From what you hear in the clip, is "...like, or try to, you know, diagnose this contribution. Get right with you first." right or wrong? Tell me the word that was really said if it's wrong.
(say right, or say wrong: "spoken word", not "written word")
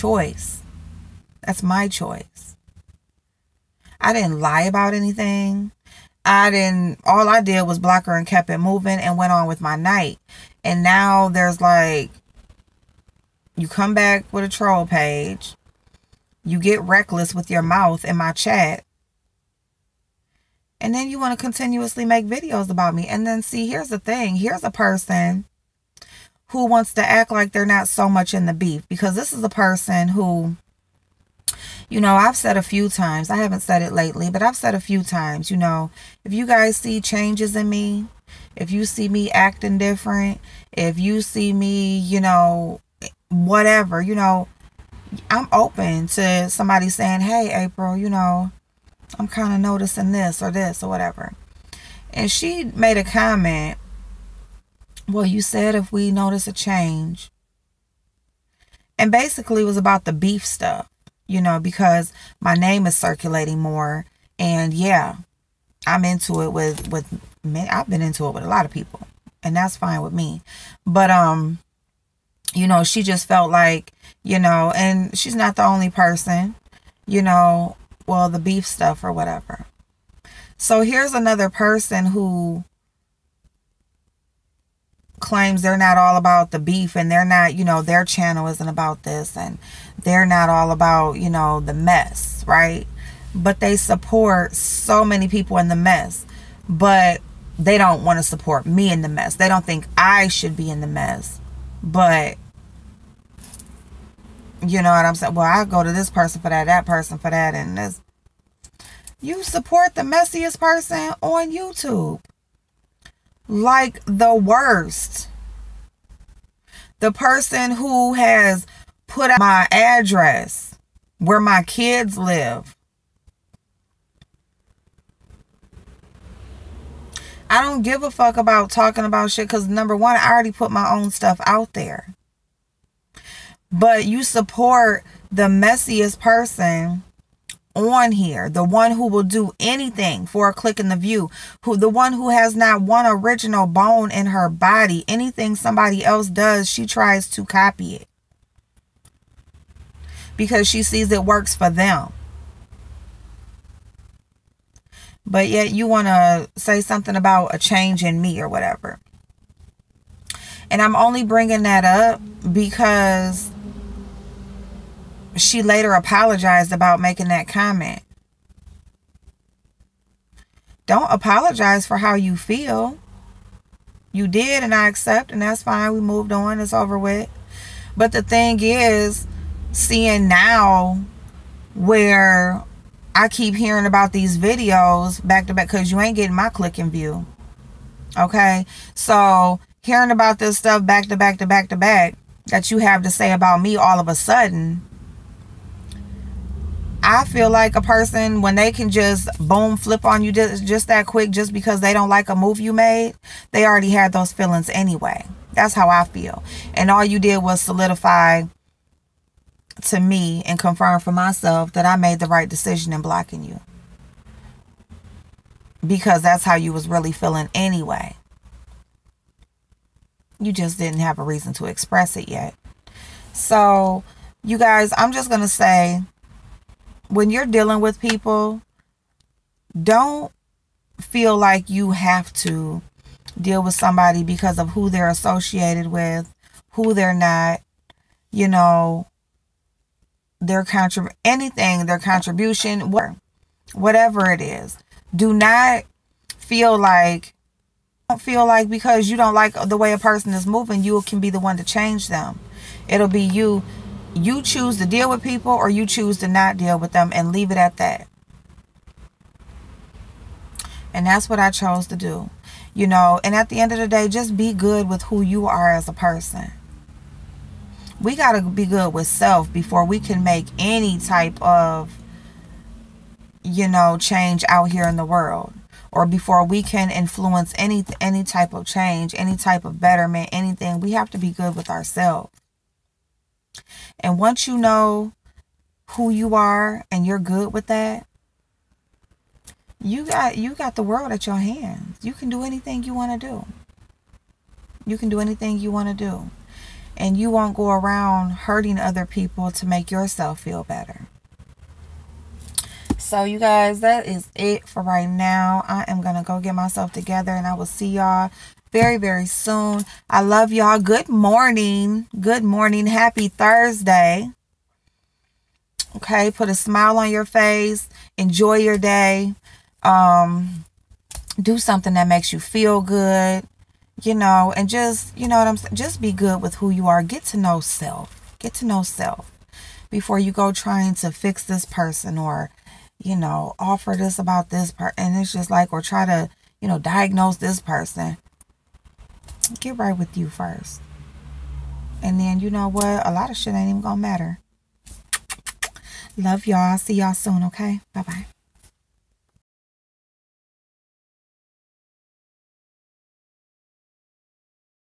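wrong: "person", not "contribution".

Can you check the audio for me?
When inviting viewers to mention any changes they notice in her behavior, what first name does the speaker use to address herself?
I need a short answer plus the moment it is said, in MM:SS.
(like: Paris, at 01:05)
April, at 00:47.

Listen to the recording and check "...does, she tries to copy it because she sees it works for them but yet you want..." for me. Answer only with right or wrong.
right.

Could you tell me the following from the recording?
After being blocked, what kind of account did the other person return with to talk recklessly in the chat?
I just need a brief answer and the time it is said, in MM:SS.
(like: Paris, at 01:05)
troll page, at 00:14.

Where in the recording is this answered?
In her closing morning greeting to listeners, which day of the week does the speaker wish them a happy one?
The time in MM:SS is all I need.
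05:13.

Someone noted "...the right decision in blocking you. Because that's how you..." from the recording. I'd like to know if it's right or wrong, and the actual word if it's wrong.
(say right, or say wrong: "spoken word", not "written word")
right.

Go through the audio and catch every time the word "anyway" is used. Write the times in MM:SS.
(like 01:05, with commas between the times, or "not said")
03:24, 03:37.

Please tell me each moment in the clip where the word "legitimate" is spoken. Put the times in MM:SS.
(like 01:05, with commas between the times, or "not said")
not said.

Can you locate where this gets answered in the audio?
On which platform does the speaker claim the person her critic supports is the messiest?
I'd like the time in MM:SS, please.
01:51.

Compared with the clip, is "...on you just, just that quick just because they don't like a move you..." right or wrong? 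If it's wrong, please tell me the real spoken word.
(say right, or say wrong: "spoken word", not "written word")
right.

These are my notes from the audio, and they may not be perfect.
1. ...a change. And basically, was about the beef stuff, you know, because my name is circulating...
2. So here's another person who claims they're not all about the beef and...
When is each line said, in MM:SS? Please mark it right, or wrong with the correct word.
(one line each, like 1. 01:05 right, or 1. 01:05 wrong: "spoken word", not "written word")
1. 00:56 right
2. 01:20 right.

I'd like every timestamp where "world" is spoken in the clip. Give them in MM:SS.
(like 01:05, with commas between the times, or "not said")
04:35, 04:50.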